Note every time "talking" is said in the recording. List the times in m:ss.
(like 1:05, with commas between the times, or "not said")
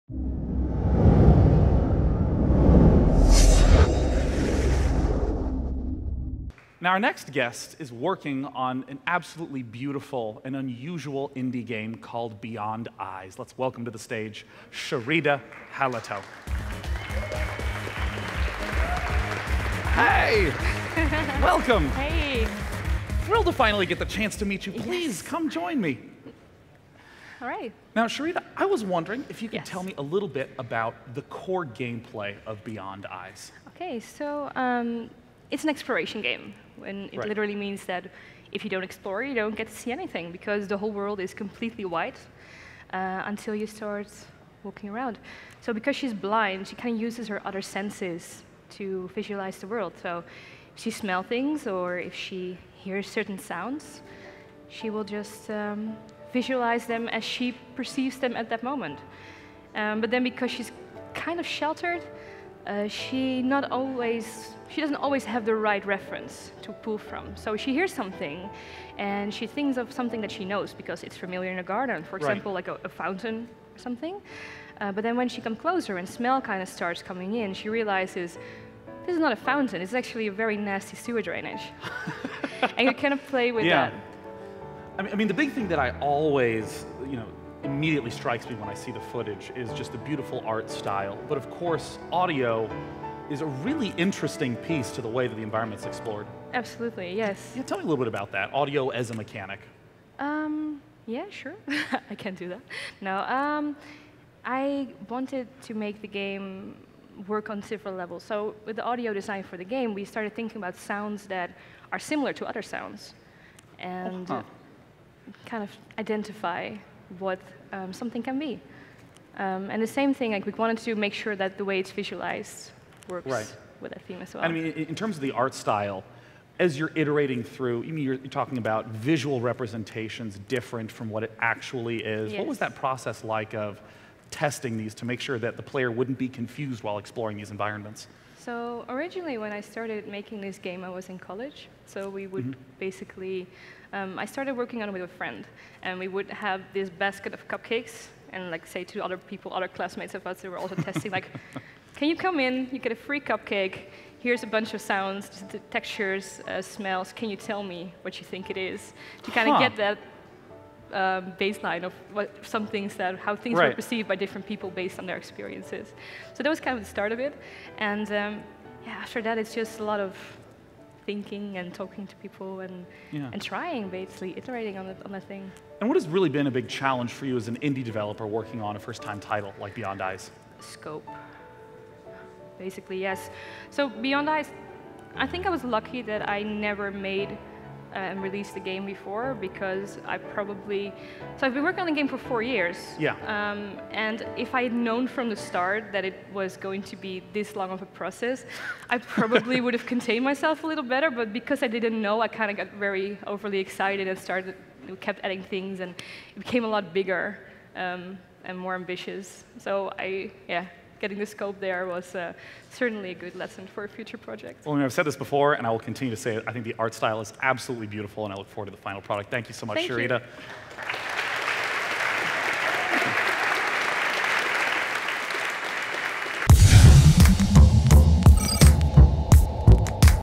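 2:08, 2:51.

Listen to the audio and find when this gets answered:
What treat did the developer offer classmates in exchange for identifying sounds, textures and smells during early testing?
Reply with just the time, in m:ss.
2:27.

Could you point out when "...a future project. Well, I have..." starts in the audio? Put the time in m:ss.
3:33.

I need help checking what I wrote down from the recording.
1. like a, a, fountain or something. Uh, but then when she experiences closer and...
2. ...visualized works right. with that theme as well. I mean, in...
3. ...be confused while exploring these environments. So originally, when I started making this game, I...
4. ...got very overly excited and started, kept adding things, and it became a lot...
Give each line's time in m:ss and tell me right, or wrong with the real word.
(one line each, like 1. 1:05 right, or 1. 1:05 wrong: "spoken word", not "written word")
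1. 1:12 wrong: "comes", not "experiences"
2. 2:01 right
3. 2:16 right
4. 3:22 right.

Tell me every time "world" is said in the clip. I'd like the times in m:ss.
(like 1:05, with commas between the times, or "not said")
0:40, 0:49.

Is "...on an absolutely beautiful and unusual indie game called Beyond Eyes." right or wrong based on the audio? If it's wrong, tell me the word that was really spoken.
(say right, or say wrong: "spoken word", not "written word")
right.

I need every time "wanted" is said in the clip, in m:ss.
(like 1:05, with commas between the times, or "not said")
1:45, 2:00.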